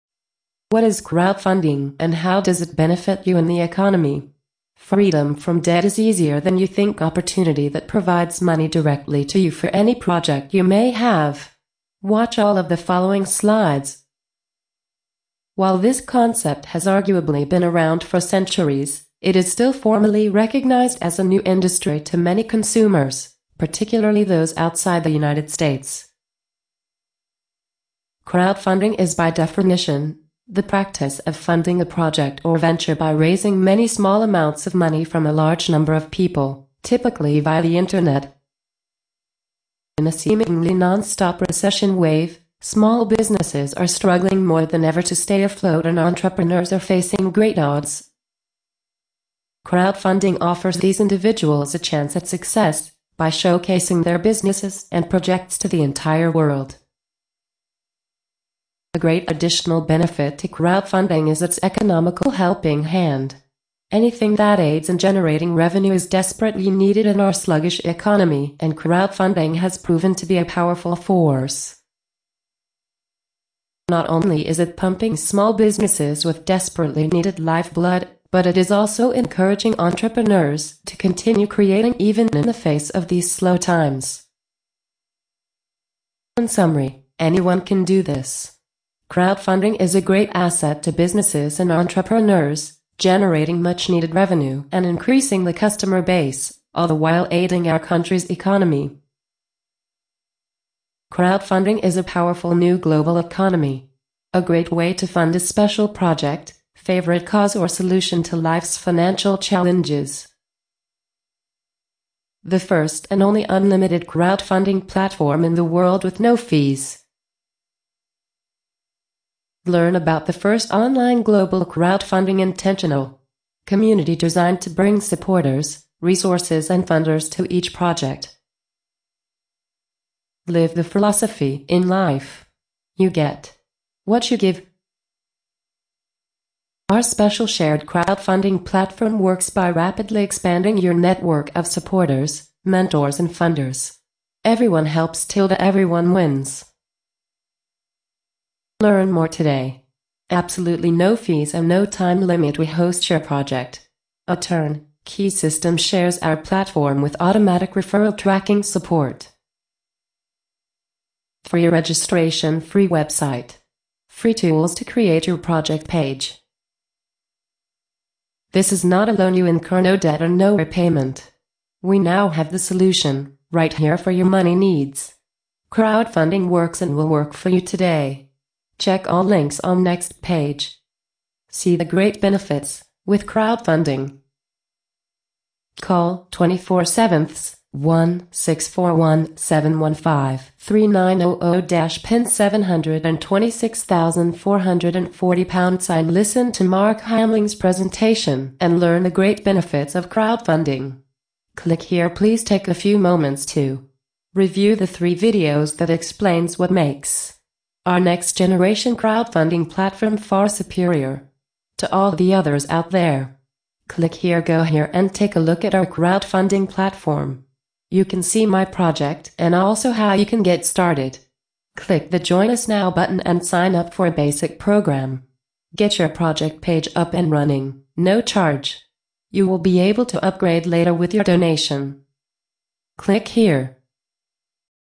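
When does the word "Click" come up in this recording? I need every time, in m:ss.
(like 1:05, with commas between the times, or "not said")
3:21, 3:33, 3:41, 3:52.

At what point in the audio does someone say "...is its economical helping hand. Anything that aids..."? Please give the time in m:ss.
1:01.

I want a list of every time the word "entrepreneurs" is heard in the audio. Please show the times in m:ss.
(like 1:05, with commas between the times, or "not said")
0:45, 1:19, 1:31.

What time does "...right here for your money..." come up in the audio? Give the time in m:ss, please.
2:53.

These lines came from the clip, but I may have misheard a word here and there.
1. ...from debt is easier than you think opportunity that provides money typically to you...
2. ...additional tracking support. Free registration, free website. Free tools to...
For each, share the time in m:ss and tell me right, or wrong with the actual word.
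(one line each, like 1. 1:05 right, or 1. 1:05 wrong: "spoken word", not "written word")
1. 0:05 wrong: "directly", not "typically"
2. 2:37 wrong: "referral", not "additional".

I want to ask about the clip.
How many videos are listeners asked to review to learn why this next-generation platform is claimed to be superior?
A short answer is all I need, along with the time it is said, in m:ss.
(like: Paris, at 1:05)
3, at 3:24.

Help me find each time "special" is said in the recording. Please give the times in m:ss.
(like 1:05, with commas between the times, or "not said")
1:45, 2:17.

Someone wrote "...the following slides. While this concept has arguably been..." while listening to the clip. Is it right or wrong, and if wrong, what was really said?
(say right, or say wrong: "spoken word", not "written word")
right.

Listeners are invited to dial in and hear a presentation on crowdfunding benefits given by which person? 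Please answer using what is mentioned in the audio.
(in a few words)
Mark Hamling.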